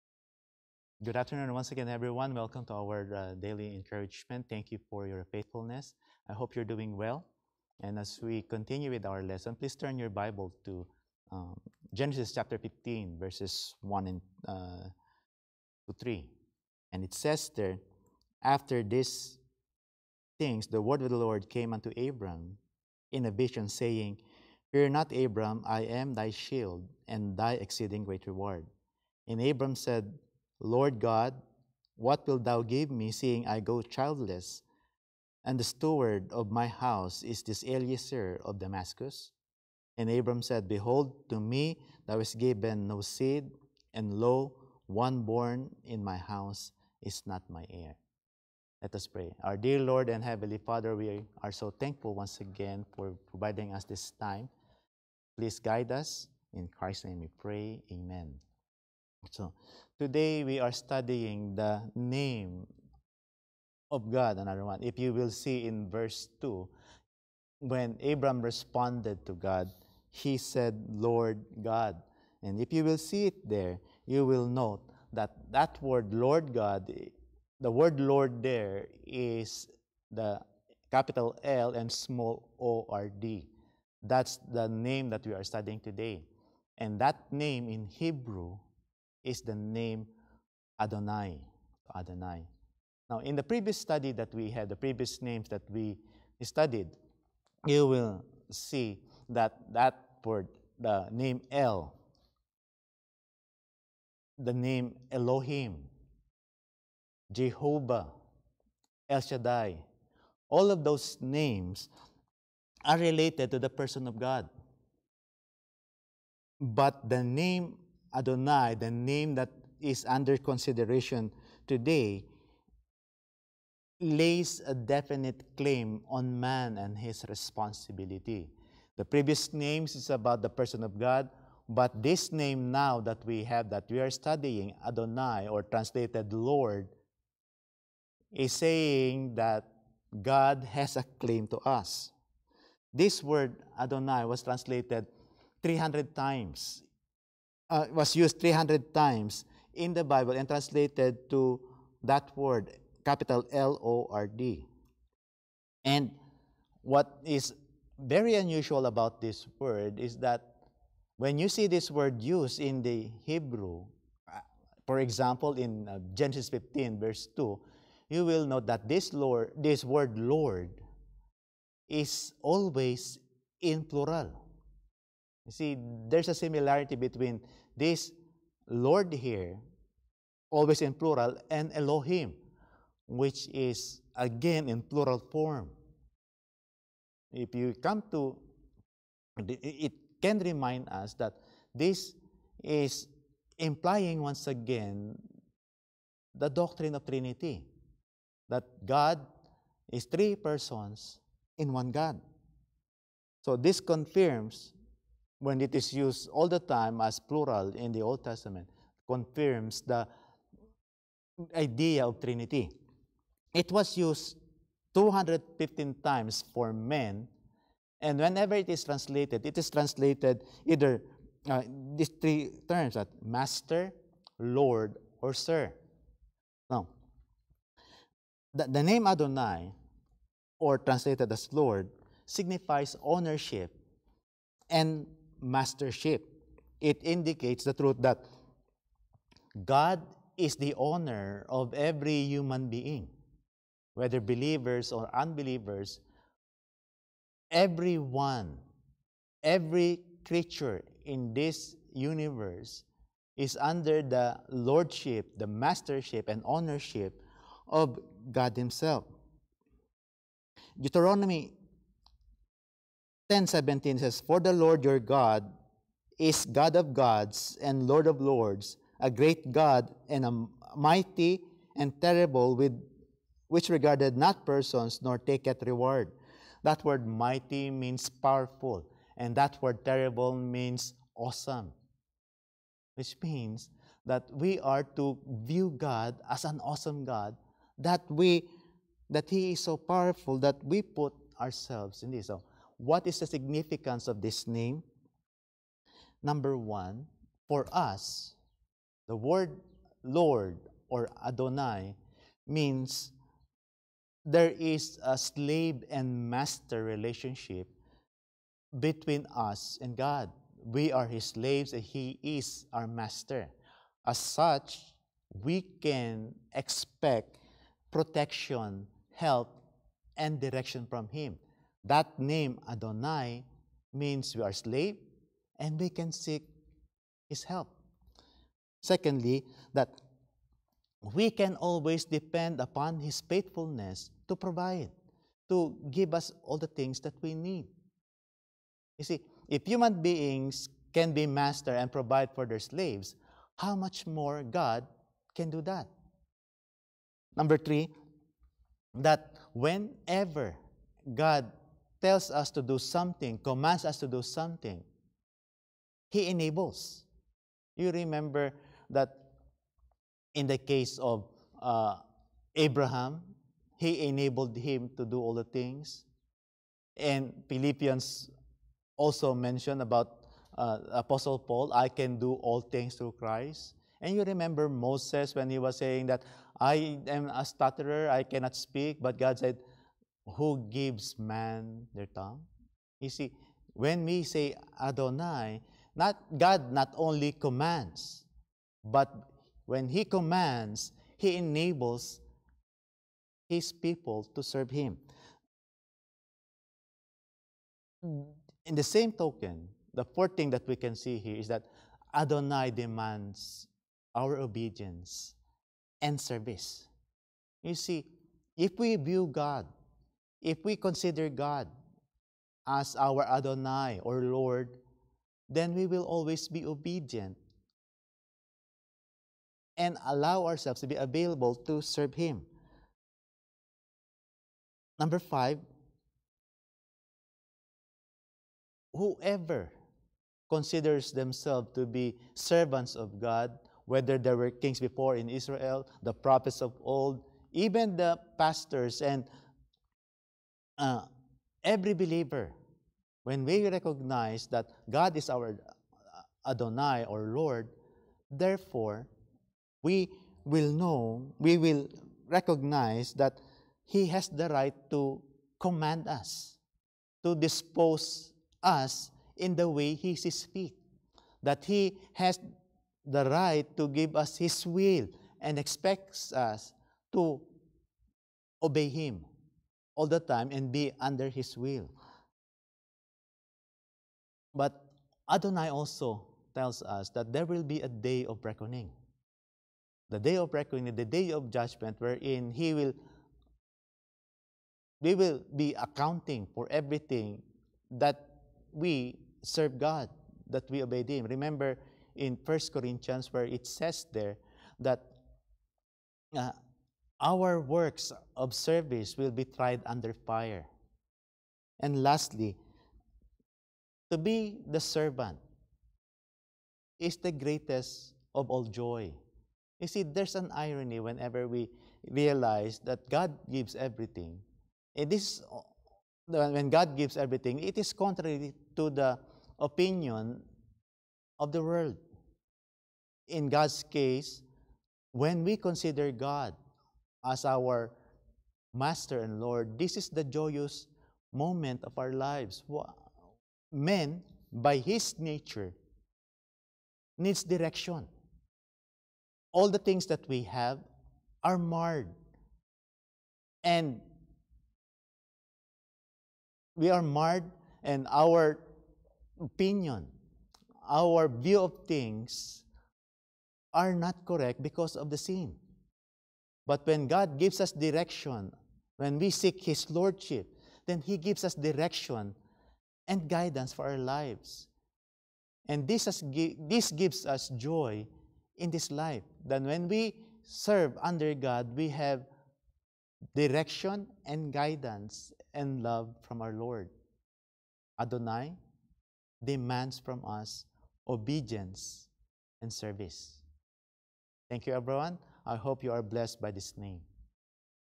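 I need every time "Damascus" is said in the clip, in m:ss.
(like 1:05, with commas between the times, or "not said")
0:38.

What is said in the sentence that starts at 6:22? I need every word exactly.
You see, when we say Adonai, not God not only commands, but when He commands, He enables His people to serve Him.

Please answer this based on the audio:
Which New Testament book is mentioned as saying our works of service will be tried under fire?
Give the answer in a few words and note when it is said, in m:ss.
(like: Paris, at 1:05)
First Corinthians, at 8:12.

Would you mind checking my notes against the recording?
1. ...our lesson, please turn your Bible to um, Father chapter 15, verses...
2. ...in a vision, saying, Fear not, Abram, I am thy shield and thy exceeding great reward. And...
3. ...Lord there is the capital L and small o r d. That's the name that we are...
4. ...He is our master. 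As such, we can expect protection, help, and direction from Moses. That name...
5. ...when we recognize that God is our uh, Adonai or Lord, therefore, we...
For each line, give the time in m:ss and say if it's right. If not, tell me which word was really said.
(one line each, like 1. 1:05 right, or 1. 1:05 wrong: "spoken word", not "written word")
1. 0:09 wrong: "Genesis", not "Father"
2. 0:23 right
3. 1:17 right
4. 5:11 wrong: "Him", not "Moses"
5. 7:23 right.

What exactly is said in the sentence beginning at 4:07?
Everyone, every creature in this universe is under the lordship, the mastership, and ownership of God Himself.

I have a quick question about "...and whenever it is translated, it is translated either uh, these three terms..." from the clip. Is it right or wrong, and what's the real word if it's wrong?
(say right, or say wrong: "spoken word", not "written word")
right.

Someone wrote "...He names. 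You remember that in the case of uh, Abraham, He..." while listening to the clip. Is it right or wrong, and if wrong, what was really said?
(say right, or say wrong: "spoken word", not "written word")
wrong: "enables", not "names".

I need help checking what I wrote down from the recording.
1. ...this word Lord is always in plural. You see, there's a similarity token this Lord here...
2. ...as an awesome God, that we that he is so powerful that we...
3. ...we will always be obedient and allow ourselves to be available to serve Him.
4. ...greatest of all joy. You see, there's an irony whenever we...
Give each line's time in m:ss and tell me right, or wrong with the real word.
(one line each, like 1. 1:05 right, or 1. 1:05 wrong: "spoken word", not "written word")
1. 2:49 wrong: "between", not "token"
2. 4:46 right
3. 6:55 right
4. 8:27 right.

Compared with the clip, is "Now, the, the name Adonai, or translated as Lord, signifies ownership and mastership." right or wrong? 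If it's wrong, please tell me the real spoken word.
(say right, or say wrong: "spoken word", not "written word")
right.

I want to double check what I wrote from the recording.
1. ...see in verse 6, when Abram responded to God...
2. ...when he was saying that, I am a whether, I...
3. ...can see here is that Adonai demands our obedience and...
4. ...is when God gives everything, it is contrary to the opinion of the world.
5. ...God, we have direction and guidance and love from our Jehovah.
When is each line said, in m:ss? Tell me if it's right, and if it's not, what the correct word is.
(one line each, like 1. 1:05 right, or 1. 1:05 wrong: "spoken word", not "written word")
1. 1:05 wrong: "2", not "6"
2. 6:15 wrong: "stutterer", not "whether"
3. 6:40 right
4. 8:35 right
5. 9:31 wrong: "Lord", not "Jehovah".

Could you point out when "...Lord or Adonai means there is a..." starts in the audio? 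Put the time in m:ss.
5:00.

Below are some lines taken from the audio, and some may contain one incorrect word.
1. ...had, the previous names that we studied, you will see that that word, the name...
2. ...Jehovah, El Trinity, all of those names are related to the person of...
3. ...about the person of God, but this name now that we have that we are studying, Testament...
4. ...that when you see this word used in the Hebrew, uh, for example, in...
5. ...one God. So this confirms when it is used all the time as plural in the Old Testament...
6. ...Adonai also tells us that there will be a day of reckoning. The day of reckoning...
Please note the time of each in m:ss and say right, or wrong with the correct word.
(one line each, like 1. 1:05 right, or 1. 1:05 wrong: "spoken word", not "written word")
1. 1:34 right
2. 1:47 wrong: "Shaddai", not "Trinity"
3. 2:10 wrong: "Adonai", not "Testament"
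4. 2:40 right
5. 3:21 right
6. 7:55 right.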